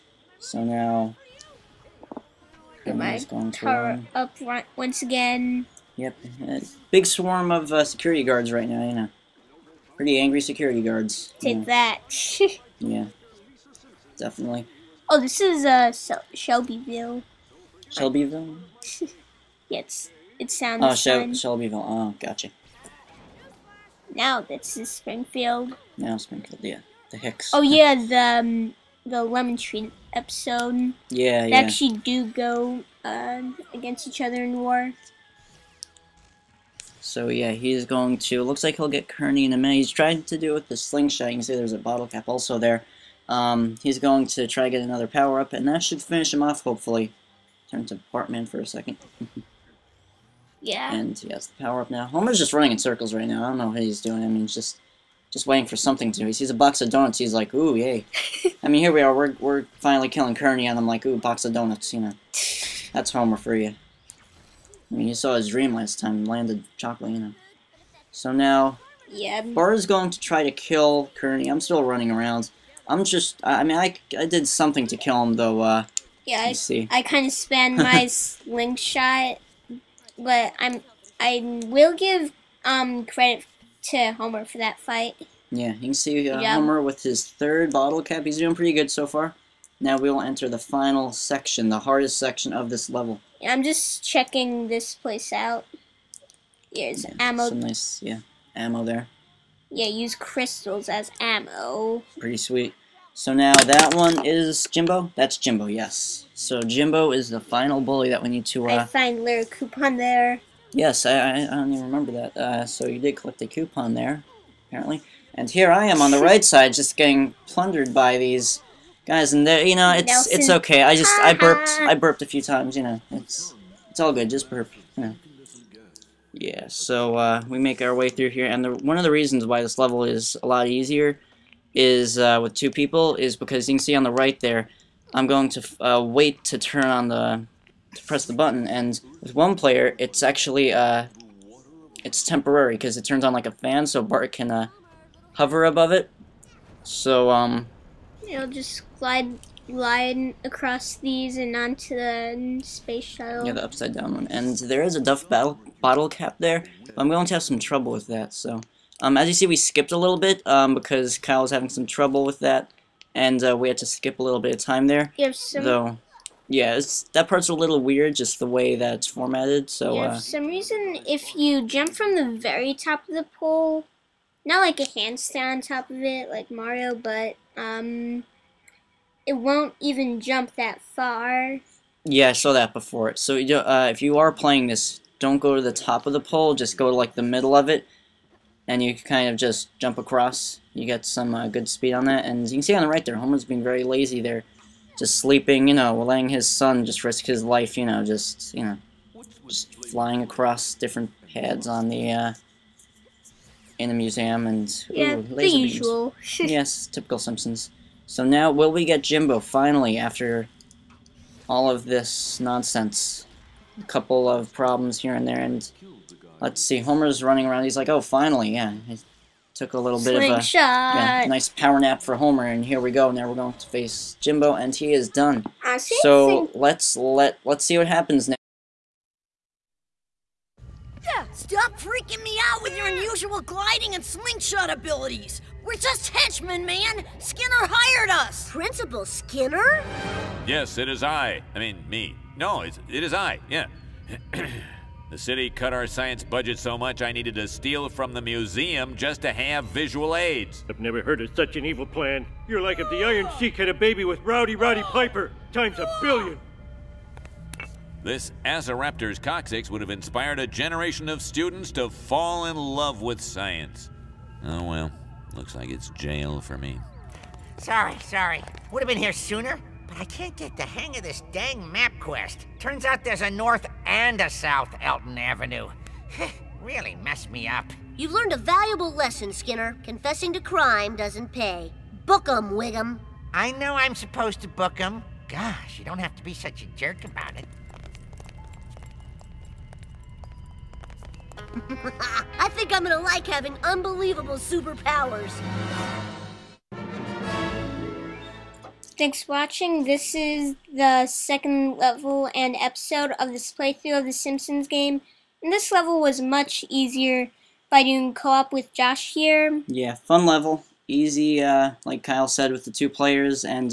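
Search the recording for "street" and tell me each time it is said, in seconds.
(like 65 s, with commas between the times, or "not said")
not said.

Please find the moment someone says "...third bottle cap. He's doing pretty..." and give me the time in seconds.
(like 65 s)
87 s.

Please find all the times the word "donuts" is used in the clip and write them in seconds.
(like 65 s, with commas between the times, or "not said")
56 s, 61 s.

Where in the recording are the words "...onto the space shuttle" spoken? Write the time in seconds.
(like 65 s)
151 s.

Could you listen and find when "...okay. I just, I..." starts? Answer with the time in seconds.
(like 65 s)
120 s.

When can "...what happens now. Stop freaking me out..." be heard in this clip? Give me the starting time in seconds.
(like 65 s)
227 s.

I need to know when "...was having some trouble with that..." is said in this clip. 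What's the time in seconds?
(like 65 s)
161 s.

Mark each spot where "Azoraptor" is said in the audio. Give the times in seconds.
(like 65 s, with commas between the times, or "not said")
258 s.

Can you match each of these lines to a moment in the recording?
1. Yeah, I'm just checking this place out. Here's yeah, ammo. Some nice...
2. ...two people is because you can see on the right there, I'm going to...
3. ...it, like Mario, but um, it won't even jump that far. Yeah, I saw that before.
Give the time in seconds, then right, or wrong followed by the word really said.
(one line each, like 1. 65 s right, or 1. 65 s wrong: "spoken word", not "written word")
1. 93 s right
2. 132 s right
3. 176 s right.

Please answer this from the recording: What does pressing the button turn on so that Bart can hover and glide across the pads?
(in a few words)
a fan.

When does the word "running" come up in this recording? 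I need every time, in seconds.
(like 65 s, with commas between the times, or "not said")
52 s, 71 s, 217 s.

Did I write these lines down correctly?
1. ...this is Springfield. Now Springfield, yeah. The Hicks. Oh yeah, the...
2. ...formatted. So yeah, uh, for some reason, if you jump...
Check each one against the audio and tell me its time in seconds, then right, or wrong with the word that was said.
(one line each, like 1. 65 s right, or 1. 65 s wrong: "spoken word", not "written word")
1. 24 s right
2. 169 s right.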